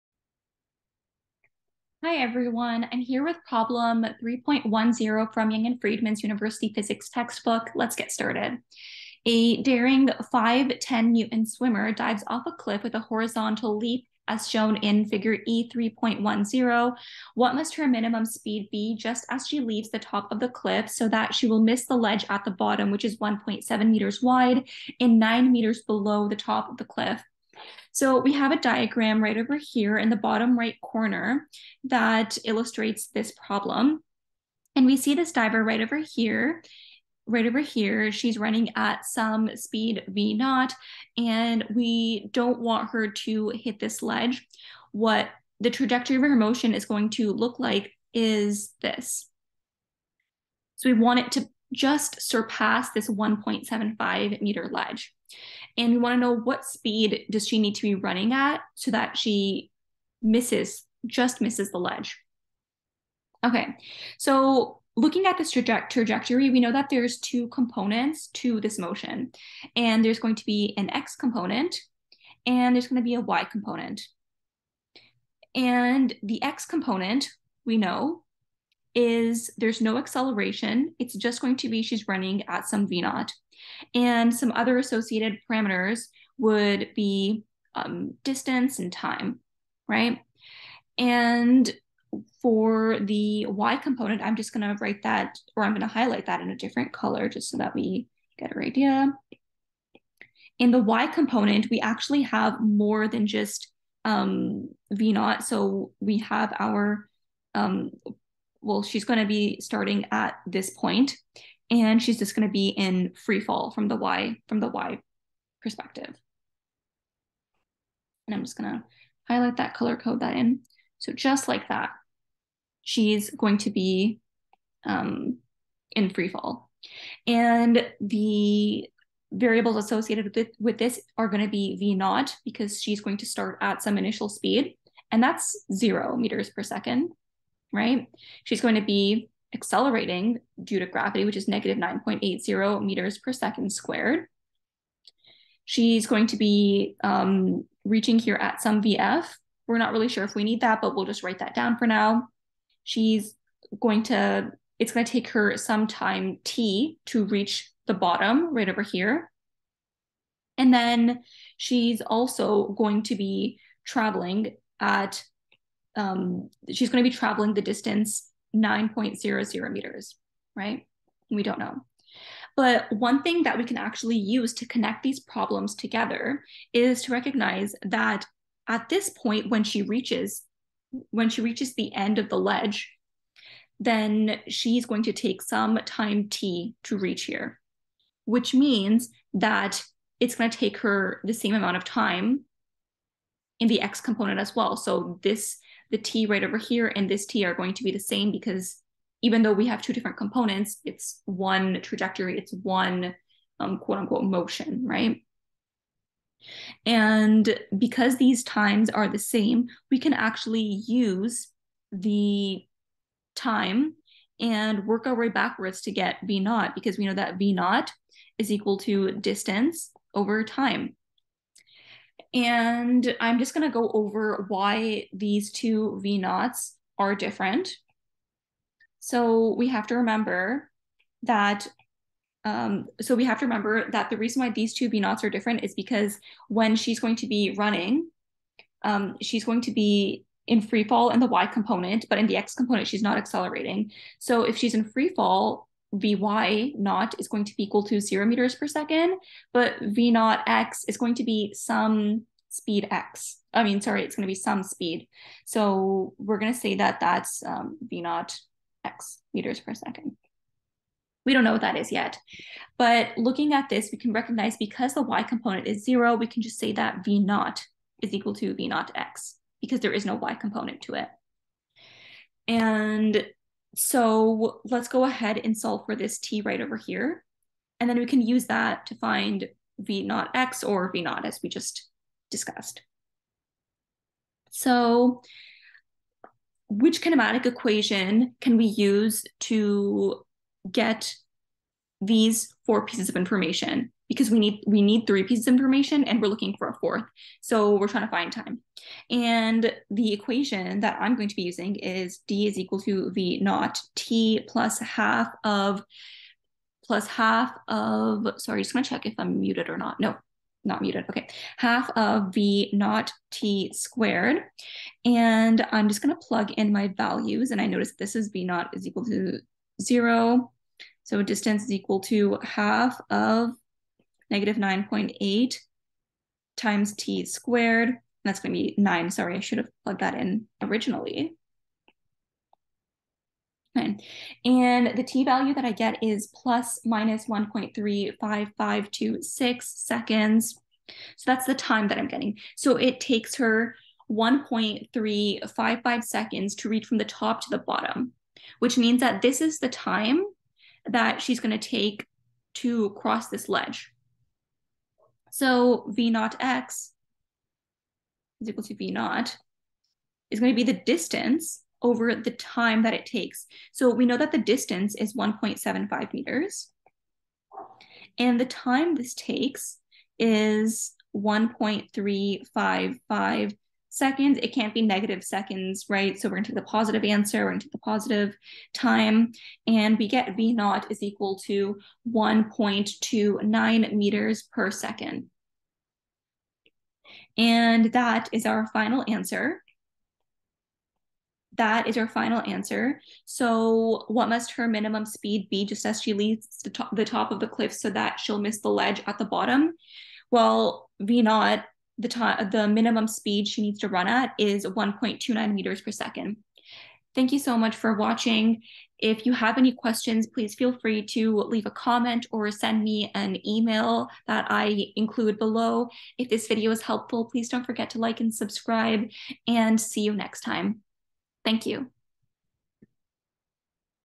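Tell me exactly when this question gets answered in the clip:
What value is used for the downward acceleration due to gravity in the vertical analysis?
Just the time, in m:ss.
2:21.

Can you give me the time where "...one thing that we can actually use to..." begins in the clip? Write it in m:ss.
2:52.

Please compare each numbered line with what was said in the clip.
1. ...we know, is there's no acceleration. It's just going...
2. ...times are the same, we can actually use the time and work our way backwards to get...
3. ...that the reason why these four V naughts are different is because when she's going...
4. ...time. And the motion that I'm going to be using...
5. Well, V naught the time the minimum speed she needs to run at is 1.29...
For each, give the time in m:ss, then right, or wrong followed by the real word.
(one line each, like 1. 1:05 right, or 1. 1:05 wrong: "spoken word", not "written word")
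1. 1:17 right
2. 3:28 right
3. 3:53 wrong: "two", not "four"
4. 4:58 wrong: "equation", not "motion"
5. 6:40 right.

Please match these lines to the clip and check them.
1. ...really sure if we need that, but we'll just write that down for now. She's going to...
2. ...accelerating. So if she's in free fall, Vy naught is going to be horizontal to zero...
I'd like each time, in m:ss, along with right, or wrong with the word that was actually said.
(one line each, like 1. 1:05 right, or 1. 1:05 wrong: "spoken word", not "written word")
1. 2:29 right
2. 4:03 wrong: "equal", not "horizontal".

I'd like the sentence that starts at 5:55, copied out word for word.
So V naught x is equal to V naught is going to be the distance over the time that it takes.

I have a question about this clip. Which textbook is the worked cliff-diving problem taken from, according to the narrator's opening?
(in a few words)
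Young and Freedman's University Physics.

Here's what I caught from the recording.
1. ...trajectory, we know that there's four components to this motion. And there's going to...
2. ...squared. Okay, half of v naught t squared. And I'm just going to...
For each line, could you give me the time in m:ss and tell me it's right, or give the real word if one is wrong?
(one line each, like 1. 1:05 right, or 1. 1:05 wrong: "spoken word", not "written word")
1. 1:05 wrong: "two", not "four"
2. 5:10 wrong: "muted", not "squared".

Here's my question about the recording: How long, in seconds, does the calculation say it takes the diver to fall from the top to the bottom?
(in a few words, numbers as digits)
1.35526 seconds.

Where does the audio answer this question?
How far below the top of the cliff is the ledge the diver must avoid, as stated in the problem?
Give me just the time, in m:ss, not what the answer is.
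0:25.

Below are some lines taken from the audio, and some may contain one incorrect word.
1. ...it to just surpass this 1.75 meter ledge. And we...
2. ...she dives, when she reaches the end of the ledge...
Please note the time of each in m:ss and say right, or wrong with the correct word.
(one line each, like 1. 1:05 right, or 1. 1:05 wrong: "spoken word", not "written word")
1. 0:51 right
2. 2:59 wrong: "reaches", not "dives".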